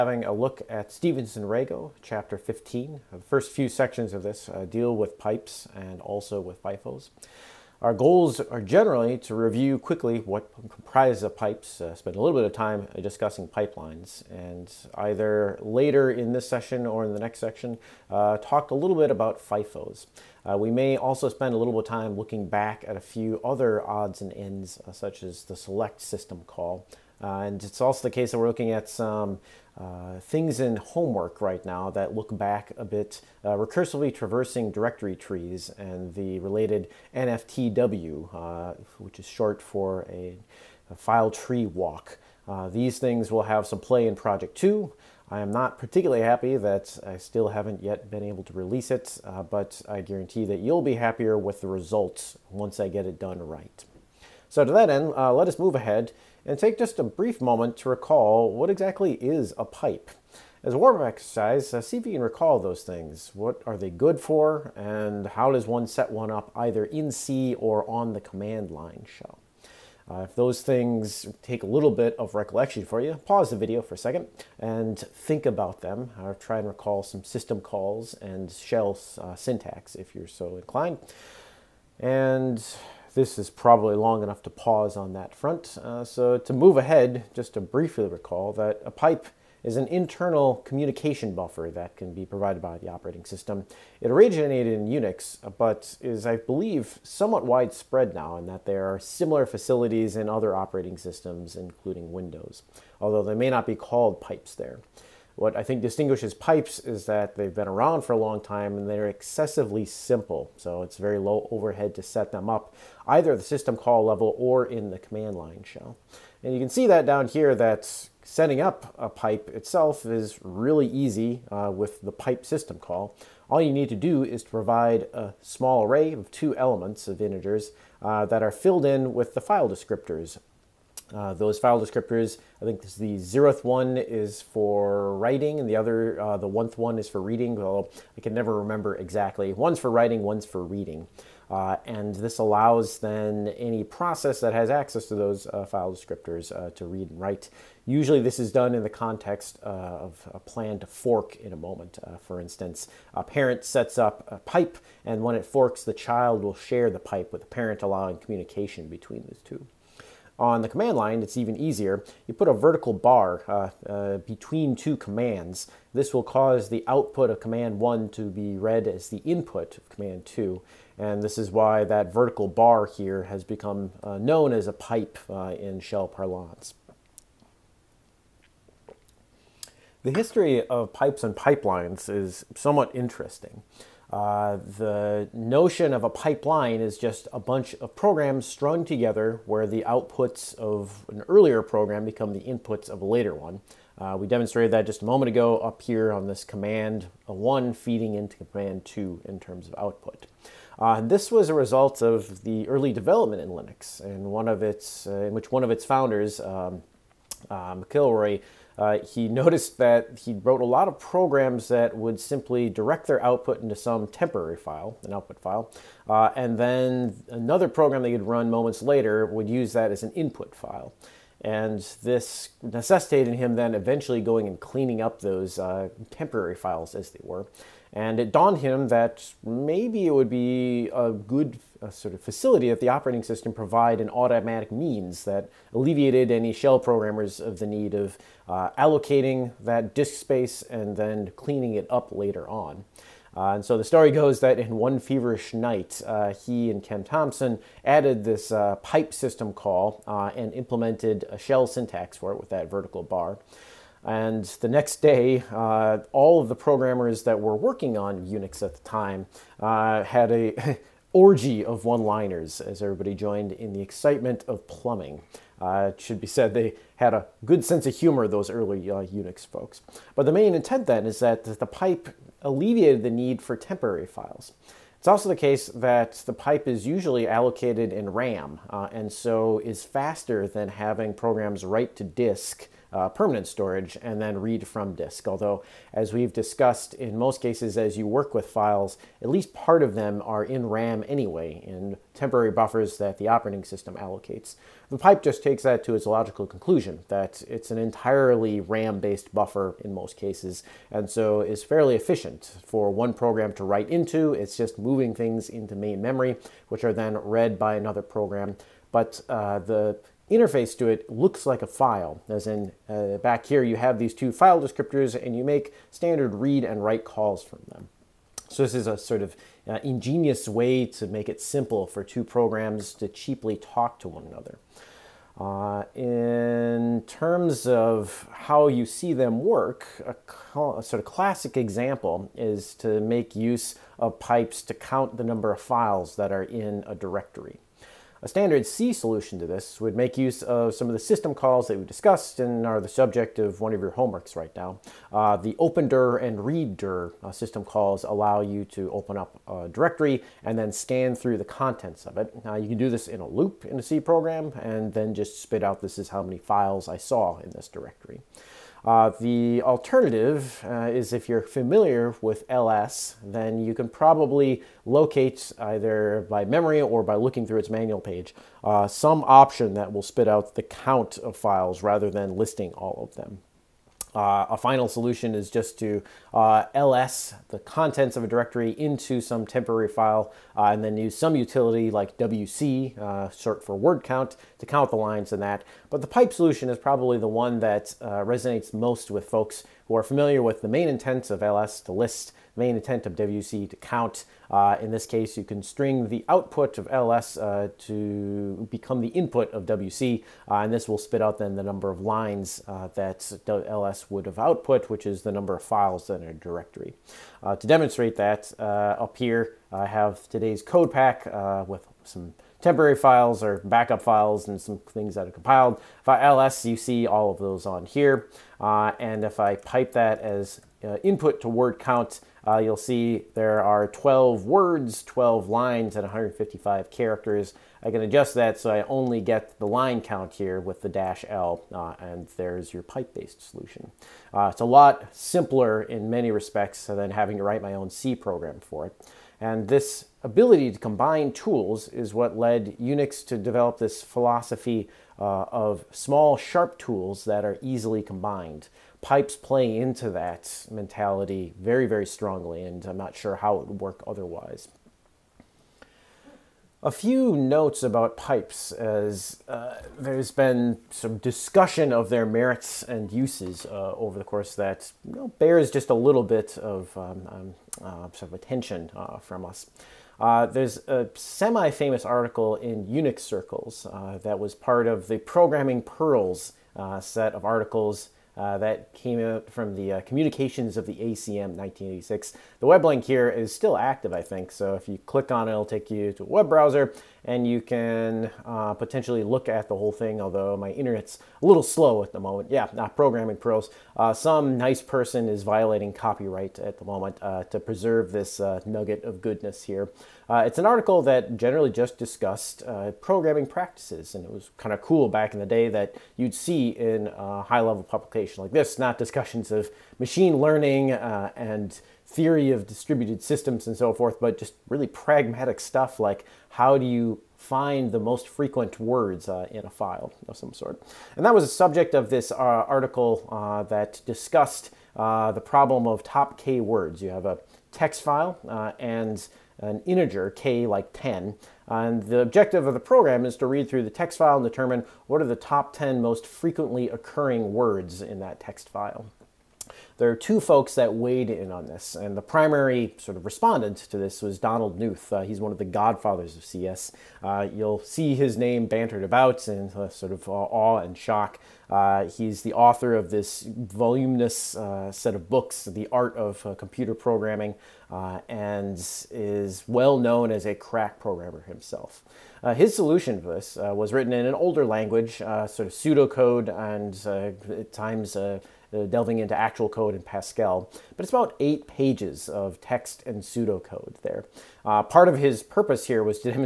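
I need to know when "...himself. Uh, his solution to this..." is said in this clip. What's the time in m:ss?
9:21.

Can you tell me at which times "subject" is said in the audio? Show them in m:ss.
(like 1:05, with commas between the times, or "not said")
5:42, 8:41.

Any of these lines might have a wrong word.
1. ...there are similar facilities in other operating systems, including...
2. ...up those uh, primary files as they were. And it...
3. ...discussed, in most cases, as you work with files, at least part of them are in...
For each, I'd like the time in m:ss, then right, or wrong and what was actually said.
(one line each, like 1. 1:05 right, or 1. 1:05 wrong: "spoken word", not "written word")
1. 1:38 right
2. 3:45 wrong: "temporary", not "primary"
3. 4:46 right.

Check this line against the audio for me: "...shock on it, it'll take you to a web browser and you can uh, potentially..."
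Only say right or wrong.
wrong.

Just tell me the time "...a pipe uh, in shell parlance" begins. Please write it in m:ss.
2:54.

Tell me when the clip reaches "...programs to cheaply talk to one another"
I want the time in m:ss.
5:22.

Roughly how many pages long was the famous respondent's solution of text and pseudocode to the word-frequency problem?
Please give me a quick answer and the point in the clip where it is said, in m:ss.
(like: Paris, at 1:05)
8 pages, at 9:31.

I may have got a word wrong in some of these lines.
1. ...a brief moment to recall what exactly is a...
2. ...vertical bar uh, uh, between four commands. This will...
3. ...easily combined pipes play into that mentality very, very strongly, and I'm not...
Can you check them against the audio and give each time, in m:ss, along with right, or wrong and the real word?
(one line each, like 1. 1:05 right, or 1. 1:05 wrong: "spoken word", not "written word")
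1. 0:56 right
2. 2:42 wrong: "two", not "four"
3. 7:27 right.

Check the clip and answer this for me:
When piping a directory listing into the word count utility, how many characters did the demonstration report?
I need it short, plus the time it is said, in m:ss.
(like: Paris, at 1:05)
155, at 7:06.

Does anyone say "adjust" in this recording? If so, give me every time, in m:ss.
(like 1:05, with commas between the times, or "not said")
7:08.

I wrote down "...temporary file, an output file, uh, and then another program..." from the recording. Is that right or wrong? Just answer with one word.
right.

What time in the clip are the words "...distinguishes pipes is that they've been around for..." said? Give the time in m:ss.
1:45.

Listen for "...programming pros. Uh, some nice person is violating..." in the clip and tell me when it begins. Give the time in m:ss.
8:12.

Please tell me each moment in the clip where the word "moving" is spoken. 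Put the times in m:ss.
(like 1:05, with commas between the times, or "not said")
5:04.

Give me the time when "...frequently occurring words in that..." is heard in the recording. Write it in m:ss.
8:56.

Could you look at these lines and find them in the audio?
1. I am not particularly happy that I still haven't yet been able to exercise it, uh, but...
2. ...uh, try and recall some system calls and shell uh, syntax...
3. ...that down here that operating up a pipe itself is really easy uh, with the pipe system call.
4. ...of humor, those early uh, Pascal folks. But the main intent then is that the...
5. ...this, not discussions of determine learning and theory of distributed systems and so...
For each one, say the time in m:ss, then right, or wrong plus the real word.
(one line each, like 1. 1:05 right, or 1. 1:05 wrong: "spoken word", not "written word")
1. 0:45 wrong: "release", not "exercise"
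2. 1:16 right
3. 1:56 wrong: "setting", not "operating"
4. 4:27 wrong: "Unix", not "Pascal"
5. 8:28 wrong: "machine", not "determine".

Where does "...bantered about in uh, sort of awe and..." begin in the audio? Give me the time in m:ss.
9:08.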